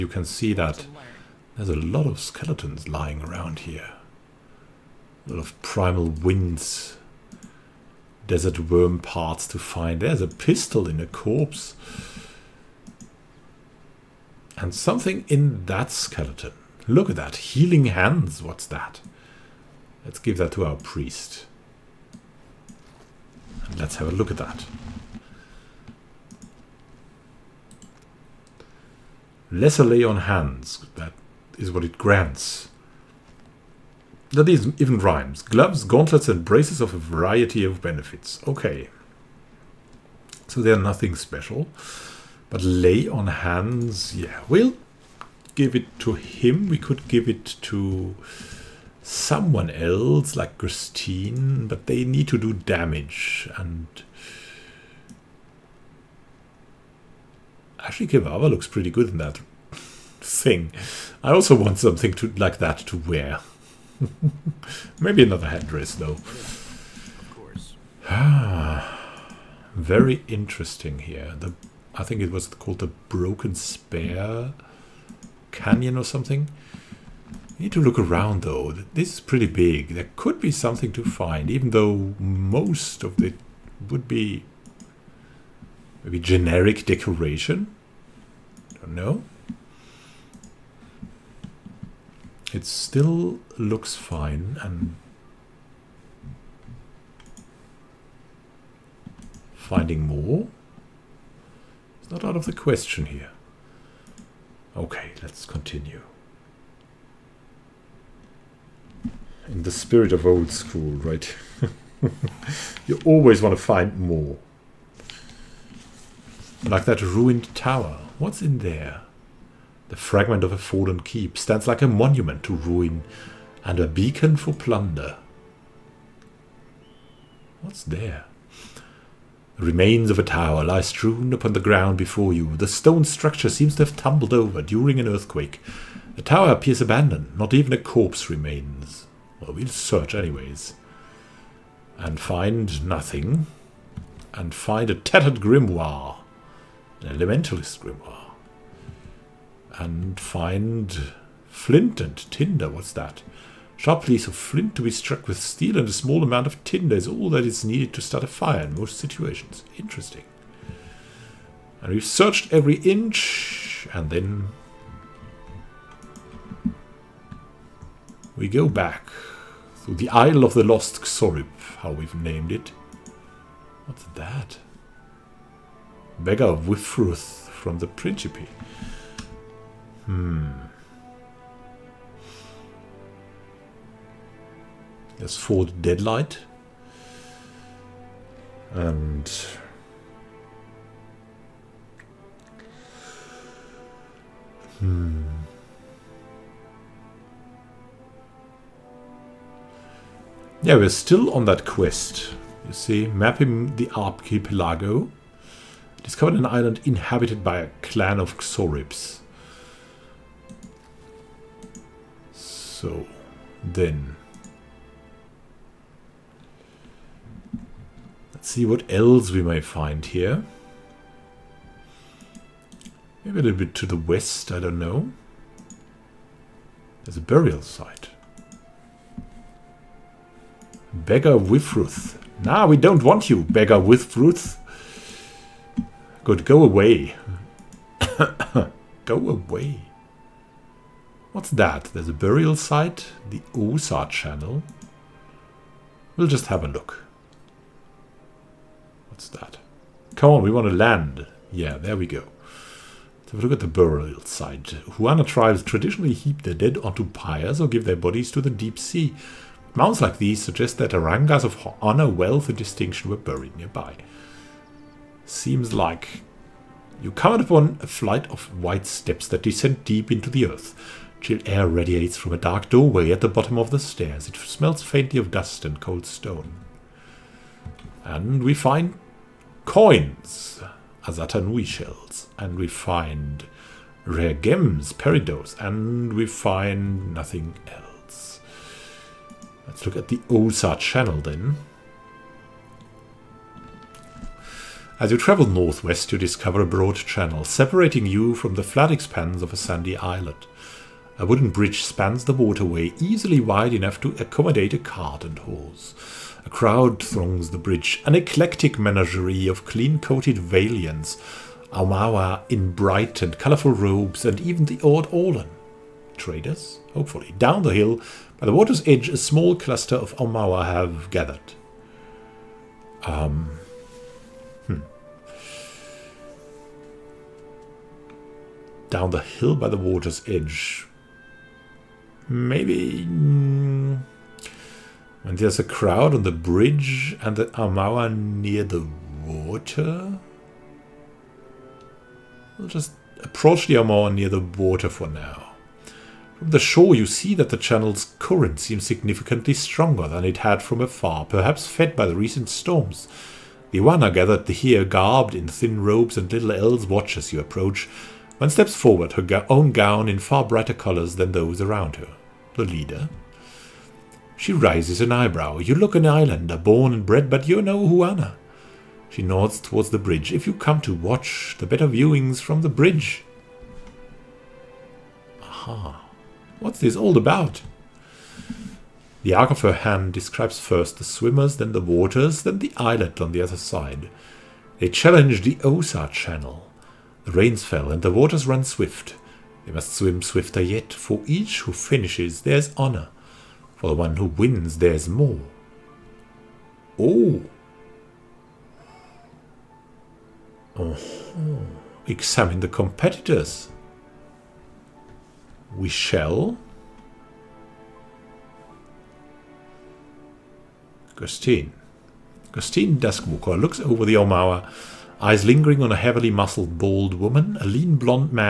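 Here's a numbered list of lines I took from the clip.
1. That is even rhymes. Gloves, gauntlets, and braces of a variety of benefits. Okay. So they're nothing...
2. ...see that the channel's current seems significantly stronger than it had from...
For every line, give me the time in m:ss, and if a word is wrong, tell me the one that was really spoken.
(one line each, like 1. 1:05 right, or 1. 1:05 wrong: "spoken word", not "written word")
1. 0:34 right
2. 5:47 right.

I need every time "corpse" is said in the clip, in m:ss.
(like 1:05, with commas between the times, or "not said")
0:11, 2:17.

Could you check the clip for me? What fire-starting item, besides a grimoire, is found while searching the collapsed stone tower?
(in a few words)
Flint and tinder.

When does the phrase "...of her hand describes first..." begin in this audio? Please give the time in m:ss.
6:19.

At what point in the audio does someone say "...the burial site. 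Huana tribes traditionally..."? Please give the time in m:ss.
4:13.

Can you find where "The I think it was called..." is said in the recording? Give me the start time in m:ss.
1:11.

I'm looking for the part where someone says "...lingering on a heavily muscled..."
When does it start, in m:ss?
6:55.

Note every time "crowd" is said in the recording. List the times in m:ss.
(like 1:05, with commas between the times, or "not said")
5:06, 5:35.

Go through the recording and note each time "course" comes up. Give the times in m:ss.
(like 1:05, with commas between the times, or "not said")
1:07.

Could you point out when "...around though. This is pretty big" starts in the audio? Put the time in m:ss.
1:17.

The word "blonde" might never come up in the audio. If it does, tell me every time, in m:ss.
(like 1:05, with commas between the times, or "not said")
6:57.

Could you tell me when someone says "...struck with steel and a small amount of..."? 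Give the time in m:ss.
2:34.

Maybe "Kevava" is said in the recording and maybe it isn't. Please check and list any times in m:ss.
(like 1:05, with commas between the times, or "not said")
0:58.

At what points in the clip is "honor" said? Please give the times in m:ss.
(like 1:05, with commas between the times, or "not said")
4:21, 6:32.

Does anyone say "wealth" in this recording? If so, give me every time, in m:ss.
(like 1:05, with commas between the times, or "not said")
4:22.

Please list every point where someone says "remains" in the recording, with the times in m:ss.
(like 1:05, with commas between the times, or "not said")
2:09, 2:18.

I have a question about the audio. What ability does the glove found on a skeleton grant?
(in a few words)
Lesser lay on hands.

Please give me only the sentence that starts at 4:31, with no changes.
Chill air radiates from a dark doorway at the bottom of the stairs.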